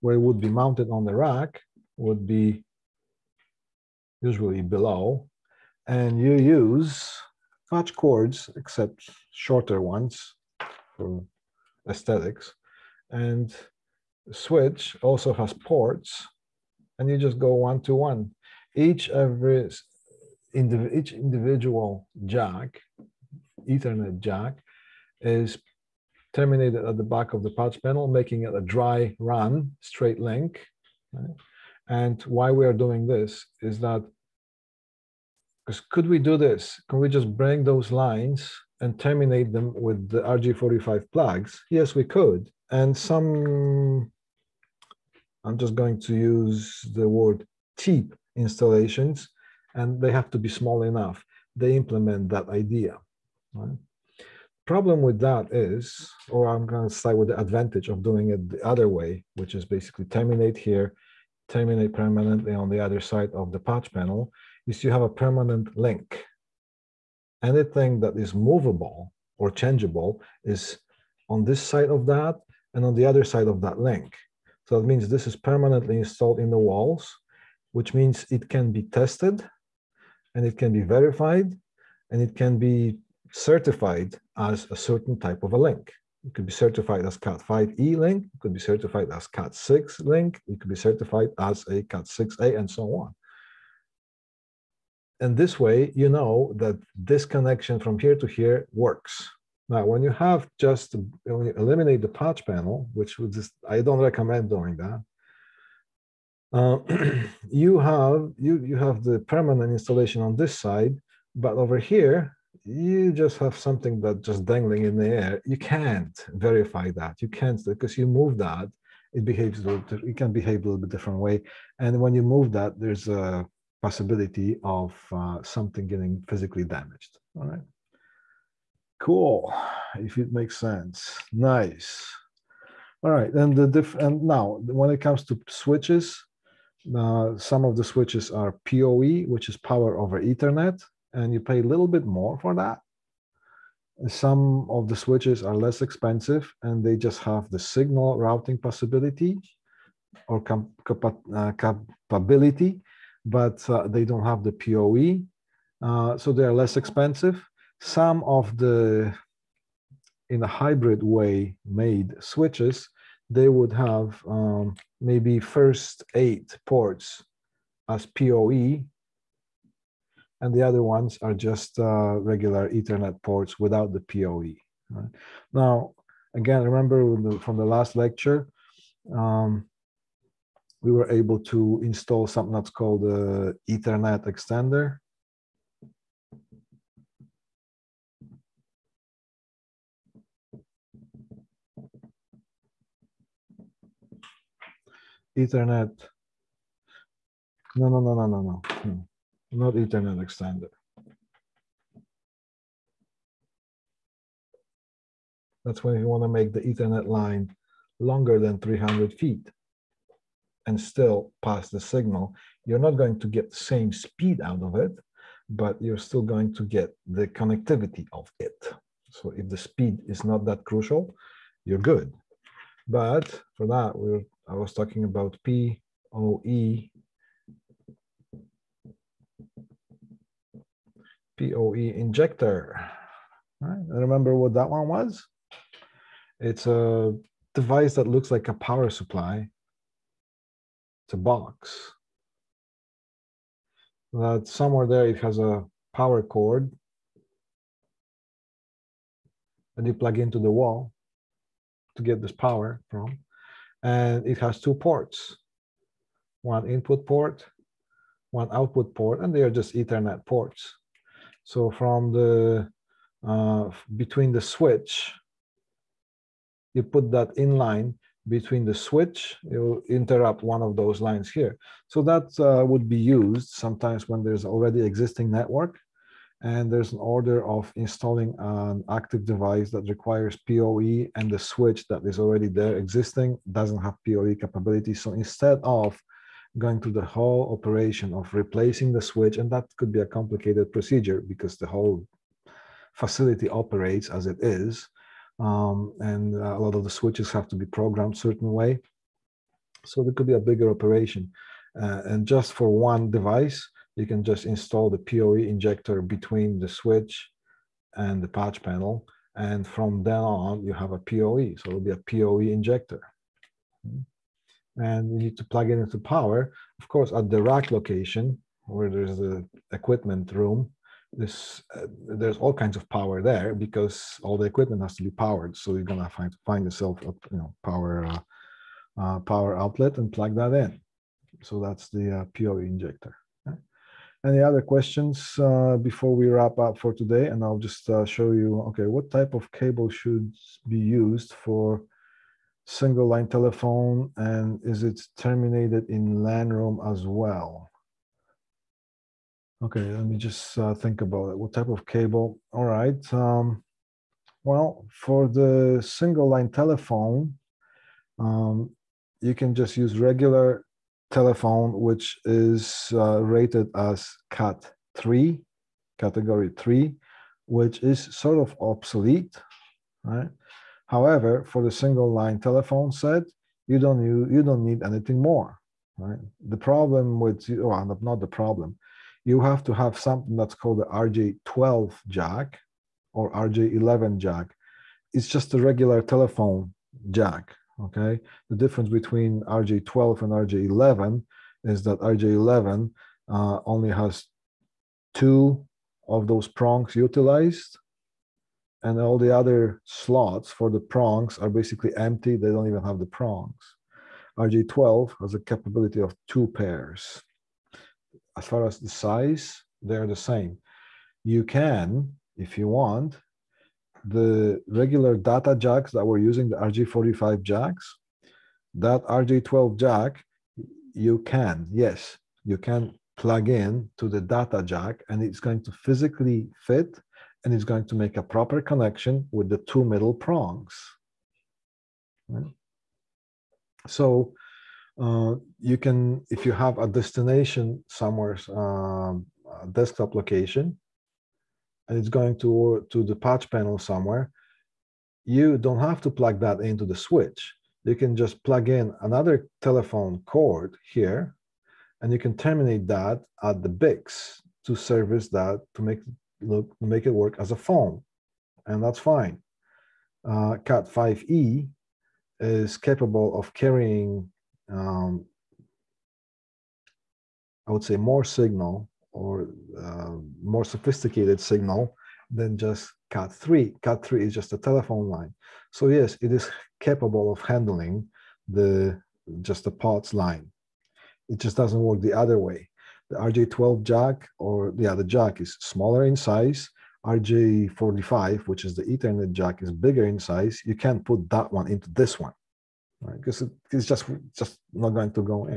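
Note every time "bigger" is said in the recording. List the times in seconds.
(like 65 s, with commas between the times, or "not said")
300 s, 489 s.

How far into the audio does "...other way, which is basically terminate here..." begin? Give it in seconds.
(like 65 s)
58 s.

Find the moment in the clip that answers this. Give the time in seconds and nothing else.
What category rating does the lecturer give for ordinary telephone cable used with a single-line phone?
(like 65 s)
365 s.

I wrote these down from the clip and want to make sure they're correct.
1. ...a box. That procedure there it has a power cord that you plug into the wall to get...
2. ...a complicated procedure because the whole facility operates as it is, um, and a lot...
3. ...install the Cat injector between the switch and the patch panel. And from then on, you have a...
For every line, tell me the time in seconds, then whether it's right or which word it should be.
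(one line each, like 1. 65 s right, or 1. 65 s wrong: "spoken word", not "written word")
1. 241 s wrong: "somewhere", not "procedure"
2. 289 s right
3. 304 s wrong: "PoE", not "Cat".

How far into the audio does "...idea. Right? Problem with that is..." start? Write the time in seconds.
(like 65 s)
52 s.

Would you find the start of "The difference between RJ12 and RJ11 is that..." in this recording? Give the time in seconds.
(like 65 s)
388 s.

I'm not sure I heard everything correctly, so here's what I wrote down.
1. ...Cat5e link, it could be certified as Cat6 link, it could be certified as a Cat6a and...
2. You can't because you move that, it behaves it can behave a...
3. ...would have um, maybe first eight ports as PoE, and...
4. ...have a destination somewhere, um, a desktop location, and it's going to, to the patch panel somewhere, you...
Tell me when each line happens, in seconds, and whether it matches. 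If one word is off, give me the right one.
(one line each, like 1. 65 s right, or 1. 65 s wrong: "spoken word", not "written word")
1. 87 s right
2. 117 s right
3. 163 s right
4. 436 s right.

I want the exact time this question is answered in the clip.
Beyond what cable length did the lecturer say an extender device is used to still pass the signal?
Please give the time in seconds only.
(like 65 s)
208 s.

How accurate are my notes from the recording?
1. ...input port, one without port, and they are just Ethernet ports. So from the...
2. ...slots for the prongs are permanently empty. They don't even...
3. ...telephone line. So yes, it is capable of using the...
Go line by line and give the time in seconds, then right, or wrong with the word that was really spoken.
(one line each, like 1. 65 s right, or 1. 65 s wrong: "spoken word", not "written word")
1. 256 s wrong: "output", not "without"
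2. 399 s wrong: "basically", not "permanently"
3. 474 s wrong: "handling", not "using".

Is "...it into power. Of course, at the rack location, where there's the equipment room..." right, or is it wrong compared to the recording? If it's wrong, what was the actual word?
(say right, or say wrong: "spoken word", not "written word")
right.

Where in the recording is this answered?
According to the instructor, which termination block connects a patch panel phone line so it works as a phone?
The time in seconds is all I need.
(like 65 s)
453 s.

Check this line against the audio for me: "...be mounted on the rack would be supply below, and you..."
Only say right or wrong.
wrong.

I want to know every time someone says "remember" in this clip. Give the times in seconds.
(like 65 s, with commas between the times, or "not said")
176 s, 233 s.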